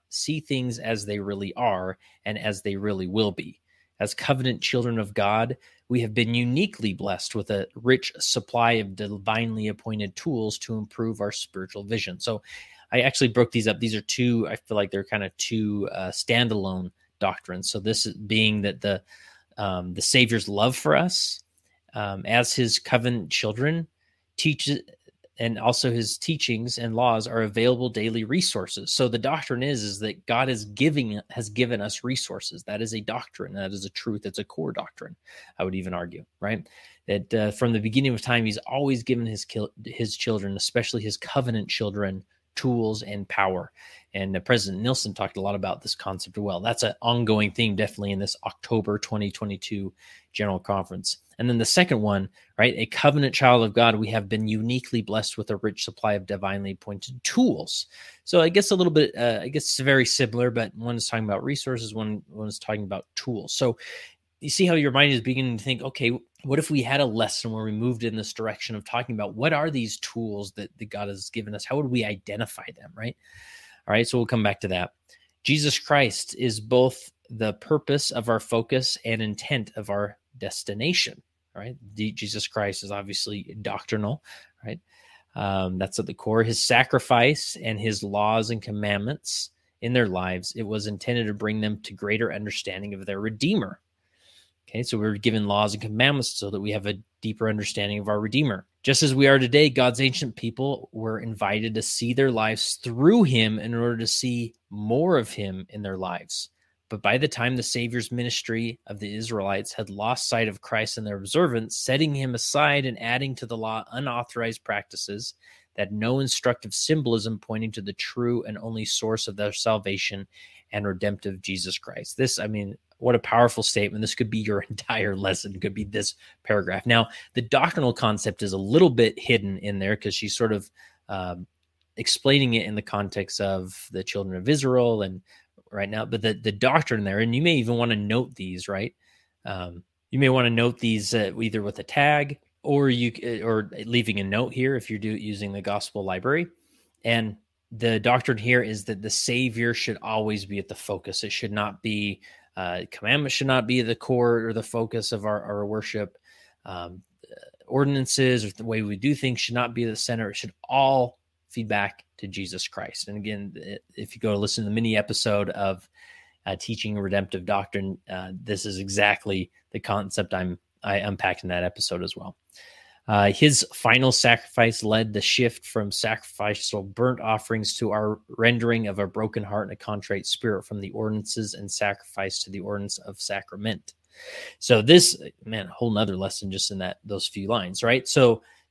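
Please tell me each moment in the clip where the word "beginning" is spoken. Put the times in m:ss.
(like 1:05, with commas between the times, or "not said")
0:37, 1:05.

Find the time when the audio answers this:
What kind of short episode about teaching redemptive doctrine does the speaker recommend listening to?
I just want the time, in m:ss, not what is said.
2:44.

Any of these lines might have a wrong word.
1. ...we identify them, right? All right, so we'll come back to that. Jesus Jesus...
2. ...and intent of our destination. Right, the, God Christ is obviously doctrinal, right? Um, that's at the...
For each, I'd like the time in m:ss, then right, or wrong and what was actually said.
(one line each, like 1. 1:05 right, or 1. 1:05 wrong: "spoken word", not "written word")
1. 1:11 wrong: "Christ", not "Jesus"
2. 1:19 wrong: "Jesus", not "God".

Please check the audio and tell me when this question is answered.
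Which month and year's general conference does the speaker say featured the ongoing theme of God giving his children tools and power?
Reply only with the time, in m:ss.
0:48.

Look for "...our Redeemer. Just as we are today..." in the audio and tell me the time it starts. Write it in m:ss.
1:38.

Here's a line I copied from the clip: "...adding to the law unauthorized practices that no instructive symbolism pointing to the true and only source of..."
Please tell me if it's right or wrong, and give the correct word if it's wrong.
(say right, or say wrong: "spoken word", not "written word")
right.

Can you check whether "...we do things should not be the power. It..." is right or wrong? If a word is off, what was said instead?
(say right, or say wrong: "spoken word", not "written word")
wrong: "center", not "power".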